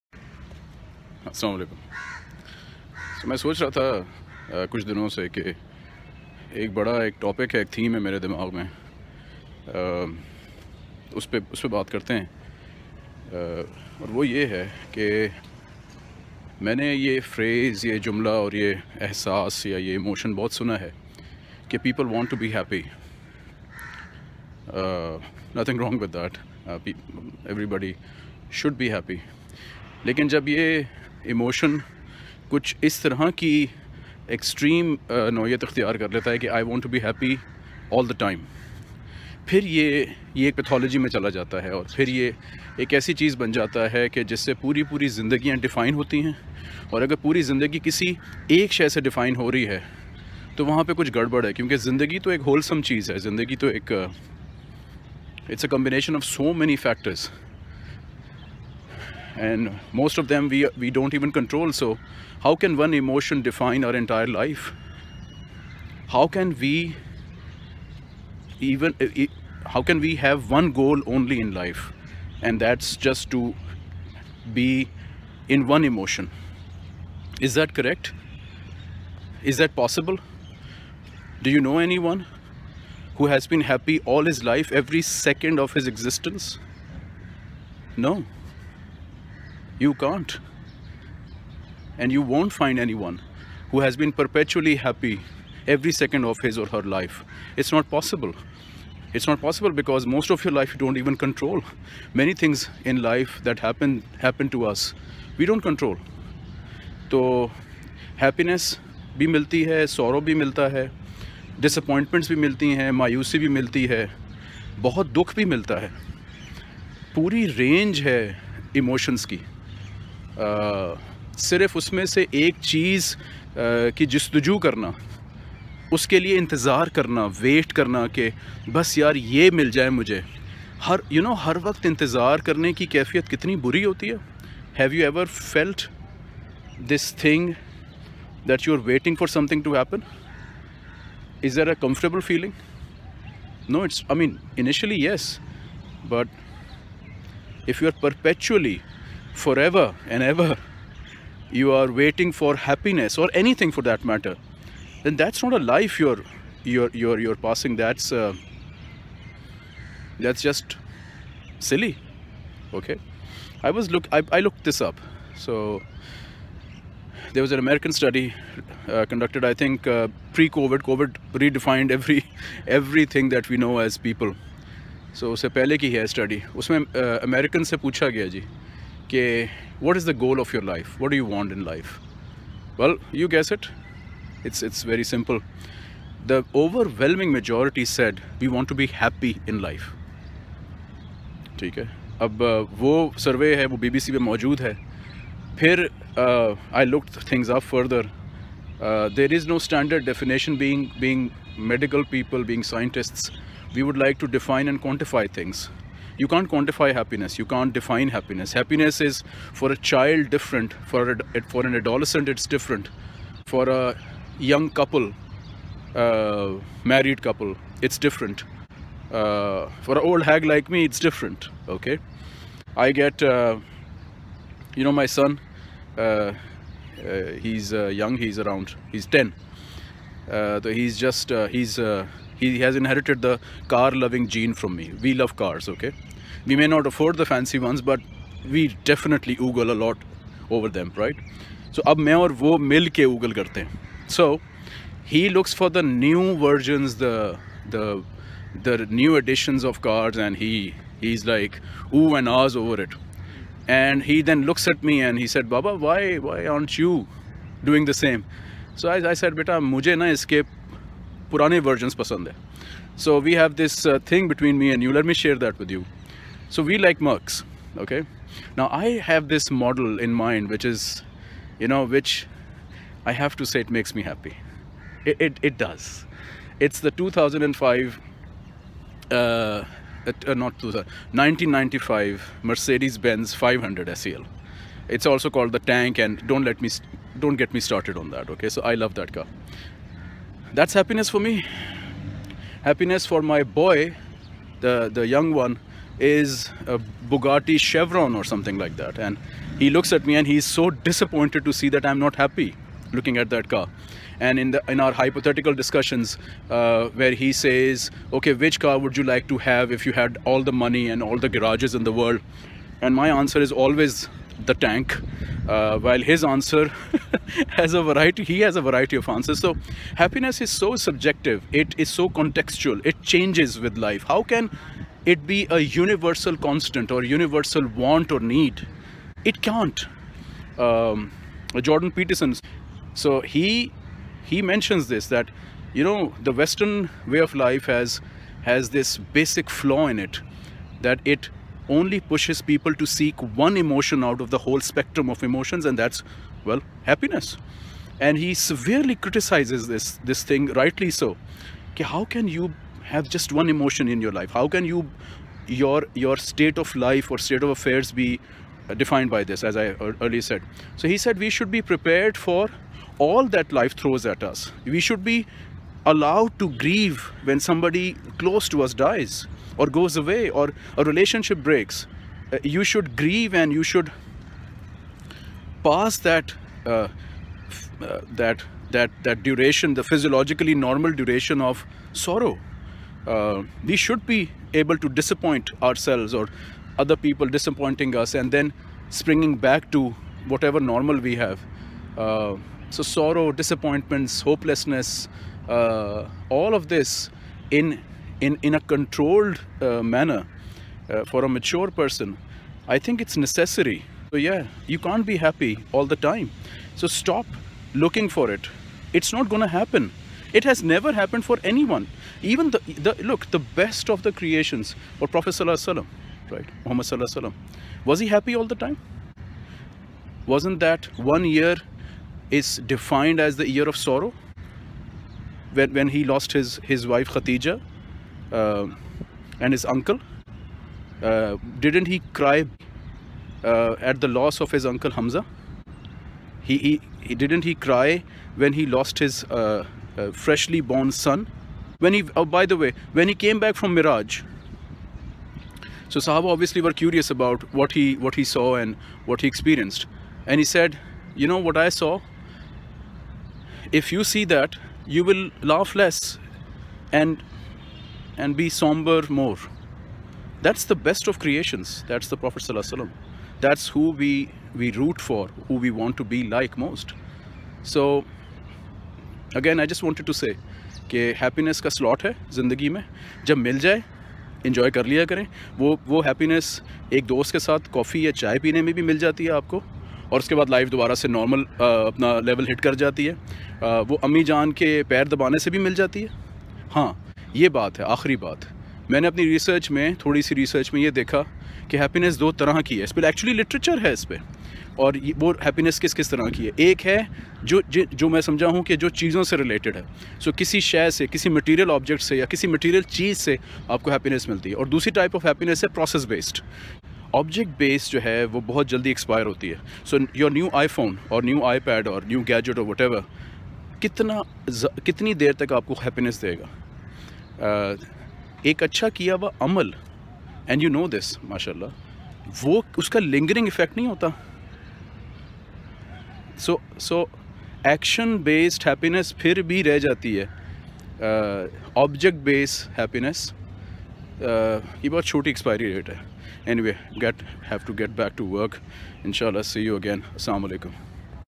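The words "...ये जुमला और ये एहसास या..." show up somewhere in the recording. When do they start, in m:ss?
0:17.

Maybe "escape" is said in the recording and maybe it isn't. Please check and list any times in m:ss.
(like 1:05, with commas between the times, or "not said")
4:20.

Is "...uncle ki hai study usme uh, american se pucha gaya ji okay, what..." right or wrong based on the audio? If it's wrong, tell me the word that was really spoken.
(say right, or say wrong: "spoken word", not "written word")
wrong: "pehle", not "uncle".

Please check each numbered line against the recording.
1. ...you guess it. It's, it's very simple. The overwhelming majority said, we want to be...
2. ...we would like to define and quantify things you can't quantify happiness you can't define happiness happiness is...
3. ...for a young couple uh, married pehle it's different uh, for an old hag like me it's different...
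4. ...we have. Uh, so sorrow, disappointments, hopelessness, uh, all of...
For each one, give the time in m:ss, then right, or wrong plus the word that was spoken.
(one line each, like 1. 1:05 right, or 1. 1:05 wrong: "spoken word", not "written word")
1. 3:03 right
2. 3:23 right
3. 3:33 wrong: "couple", not "pehle"
4. 6:30 right.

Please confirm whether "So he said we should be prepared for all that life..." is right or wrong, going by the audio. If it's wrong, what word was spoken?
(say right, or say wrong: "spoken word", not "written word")
right.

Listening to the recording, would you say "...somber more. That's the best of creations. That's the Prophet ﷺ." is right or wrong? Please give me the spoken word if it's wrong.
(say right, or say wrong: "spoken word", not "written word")
right.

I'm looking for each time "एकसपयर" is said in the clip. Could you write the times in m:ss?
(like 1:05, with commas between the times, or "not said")
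8:28, 8:55.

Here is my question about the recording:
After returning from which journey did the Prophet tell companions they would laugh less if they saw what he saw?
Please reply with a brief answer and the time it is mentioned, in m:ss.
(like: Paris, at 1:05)
Miraj, at 7:23.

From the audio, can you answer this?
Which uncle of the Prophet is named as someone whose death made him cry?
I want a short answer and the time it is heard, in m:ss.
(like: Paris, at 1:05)
Hamza, at 7:14.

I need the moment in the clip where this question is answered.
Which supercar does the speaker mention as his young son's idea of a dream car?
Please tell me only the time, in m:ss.
4:57.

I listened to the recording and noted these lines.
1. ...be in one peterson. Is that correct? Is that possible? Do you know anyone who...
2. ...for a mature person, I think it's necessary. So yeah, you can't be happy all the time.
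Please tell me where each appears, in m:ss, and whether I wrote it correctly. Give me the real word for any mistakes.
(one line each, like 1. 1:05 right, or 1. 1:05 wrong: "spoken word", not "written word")
1. 1:14 wrong: "emotion", not "peterson"
2. 6:41 right.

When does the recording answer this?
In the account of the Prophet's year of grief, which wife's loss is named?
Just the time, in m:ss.
7:07.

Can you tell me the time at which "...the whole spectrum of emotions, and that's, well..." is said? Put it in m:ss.
5:44.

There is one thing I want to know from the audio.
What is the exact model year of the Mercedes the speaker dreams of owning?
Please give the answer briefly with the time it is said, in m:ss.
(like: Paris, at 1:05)
1995, at 4:41.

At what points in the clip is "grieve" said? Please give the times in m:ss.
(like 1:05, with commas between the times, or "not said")
6:06, 6:12.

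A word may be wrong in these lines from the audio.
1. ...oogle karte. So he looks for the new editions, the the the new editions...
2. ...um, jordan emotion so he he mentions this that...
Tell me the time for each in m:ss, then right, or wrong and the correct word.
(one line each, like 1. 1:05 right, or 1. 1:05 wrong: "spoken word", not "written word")
1. 4:03 wrong: "versions", not "editions"
2. 5:30 wrong: "peterson", not "emotion".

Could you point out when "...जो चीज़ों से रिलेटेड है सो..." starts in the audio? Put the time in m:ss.
8:18.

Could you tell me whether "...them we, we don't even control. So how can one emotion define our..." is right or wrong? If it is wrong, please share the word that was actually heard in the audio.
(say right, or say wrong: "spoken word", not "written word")
right.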